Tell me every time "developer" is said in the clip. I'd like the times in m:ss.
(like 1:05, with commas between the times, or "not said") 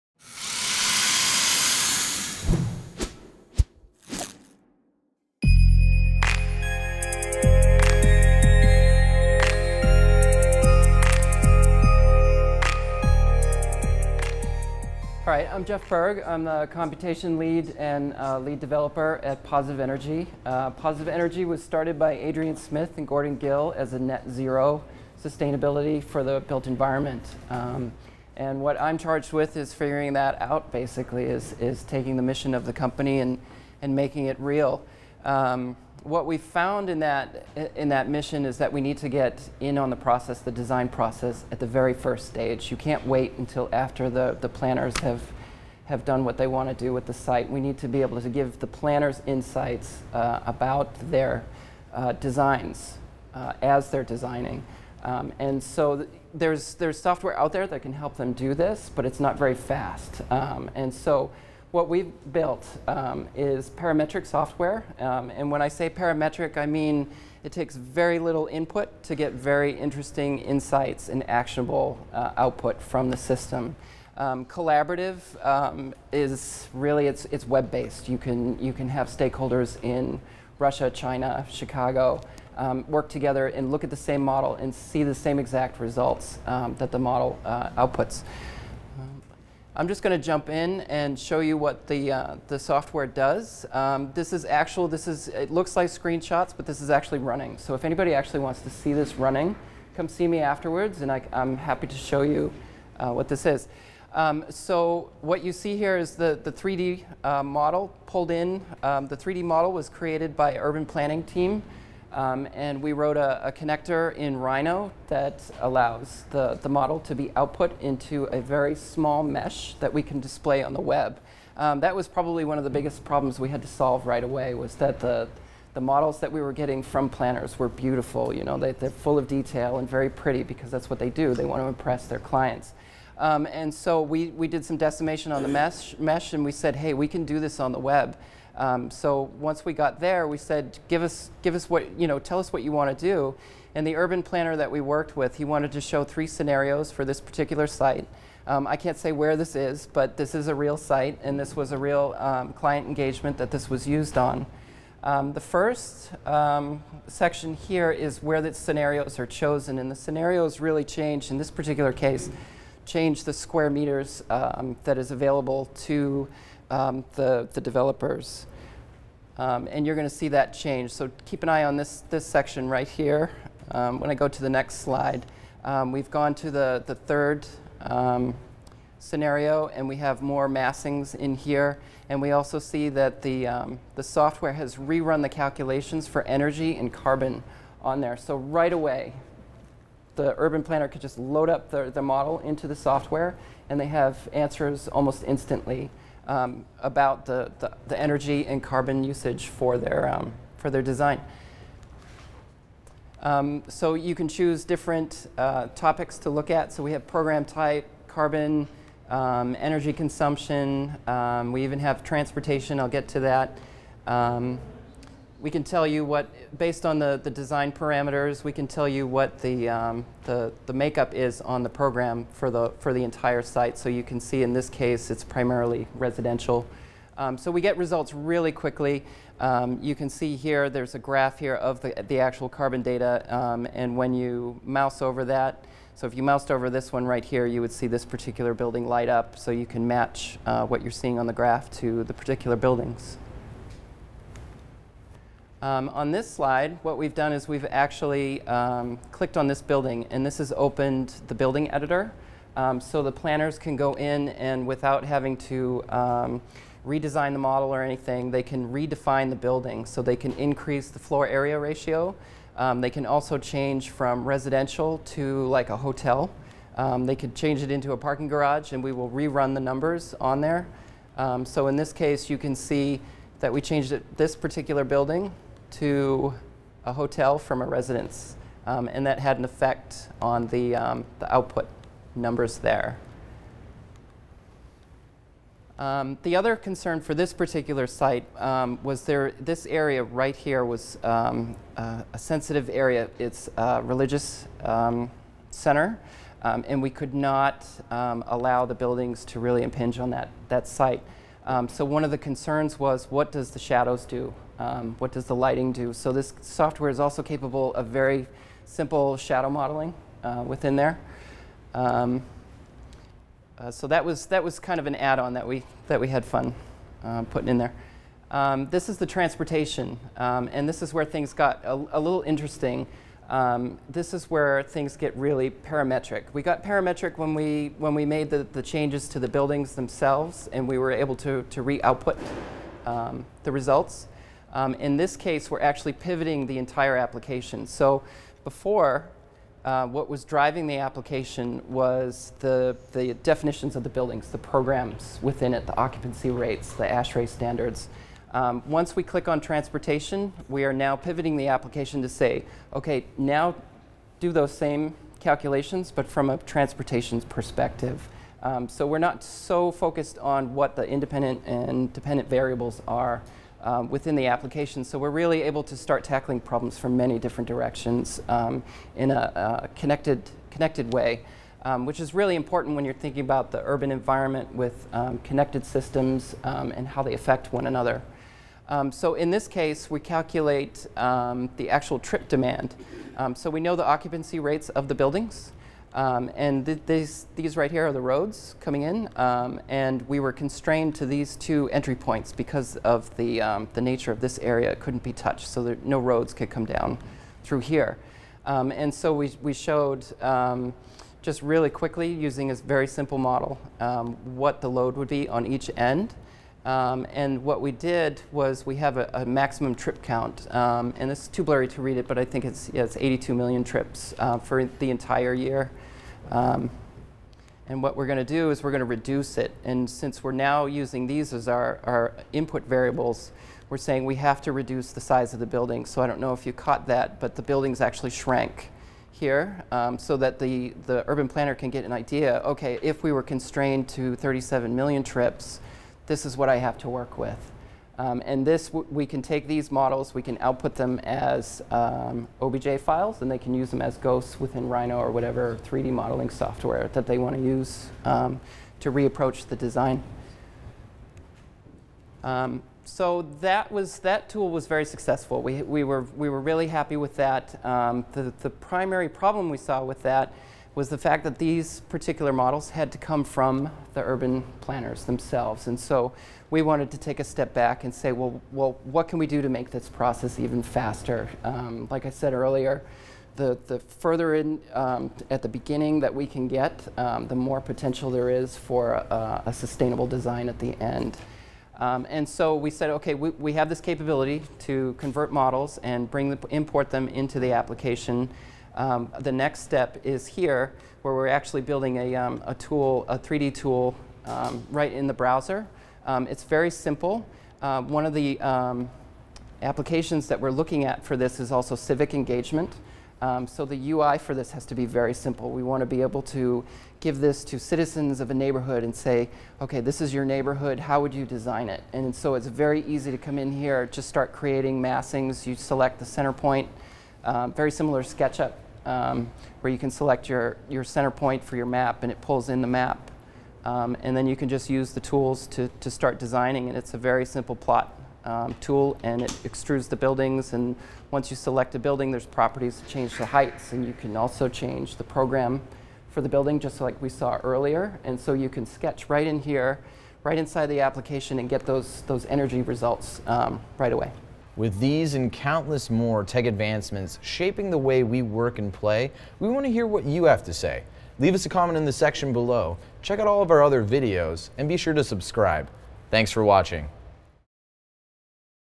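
0:18, 2:47.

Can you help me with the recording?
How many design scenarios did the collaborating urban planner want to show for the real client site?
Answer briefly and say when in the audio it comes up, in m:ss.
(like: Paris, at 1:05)
3, at 2:26.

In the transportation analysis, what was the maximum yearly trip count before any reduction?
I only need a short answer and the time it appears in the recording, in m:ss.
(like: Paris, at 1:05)
82 million, at 6:52.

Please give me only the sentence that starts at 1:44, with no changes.
Um, so what you see here is the, the 3D uh, model pulled in.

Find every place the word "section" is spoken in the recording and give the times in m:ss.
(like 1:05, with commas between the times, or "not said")
2:37, 2:52, 9:11.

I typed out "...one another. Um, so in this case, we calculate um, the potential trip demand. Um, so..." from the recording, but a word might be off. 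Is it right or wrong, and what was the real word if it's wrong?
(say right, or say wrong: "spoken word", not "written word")
wrong: "actual", not "potential".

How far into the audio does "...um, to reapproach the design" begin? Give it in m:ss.
7:28.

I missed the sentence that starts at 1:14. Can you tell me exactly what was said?
Um, collaborative um, is really it's it's web based.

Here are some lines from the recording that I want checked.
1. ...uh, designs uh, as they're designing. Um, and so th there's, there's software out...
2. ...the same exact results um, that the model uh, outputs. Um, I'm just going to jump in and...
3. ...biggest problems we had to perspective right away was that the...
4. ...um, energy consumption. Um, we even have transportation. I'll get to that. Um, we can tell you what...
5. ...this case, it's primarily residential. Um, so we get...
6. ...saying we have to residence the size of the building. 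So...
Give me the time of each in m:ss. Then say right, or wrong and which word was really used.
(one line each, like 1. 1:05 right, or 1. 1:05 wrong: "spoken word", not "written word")
1. 0:51 right
2. 1:25 right
3. 2:02 wrong: "solve", not "perspective"
4. 3:29 right
5. 3:44 right
6. 7:03 wrong: "reduce", not "residence".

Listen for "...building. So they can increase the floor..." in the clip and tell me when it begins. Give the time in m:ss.
4:19.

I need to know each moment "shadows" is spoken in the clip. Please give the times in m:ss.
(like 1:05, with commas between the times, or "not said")
5:03, 5:09.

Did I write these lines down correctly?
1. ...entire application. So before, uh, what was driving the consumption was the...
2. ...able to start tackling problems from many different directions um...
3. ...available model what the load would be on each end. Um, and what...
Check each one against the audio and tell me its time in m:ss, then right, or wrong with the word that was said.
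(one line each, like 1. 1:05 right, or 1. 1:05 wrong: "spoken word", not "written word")
1. 5:36 wrong: "application", not "consumption"
2. 6:05 right
3. 6:42 wrong: "simple", not "available".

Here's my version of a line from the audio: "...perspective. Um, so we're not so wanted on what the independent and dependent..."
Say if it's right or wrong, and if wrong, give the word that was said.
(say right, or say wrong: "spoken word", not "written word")
wrong: "focused", not "wanted".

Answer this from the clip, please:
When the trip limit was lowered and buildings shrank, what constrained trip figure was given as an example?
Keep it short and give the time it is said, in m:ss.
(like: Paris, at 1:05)
37 million, at 7:14.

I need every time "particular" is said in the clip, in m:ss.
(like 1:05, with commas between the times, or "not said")
2:27, 2:41, 3:58, 4:02, 4:34, 4:47, 7:41.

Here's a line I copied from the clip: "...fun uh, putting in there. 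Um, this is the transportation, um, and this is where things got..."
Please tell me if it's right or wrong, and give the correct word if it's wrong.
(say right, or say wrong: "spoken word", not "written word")
right.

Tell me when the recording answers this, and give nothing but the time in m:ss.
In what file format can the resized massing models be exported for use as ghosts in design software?
7:22.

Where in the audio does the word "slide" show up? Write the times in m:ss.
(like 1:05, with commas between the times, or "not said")
2:54, 4:06.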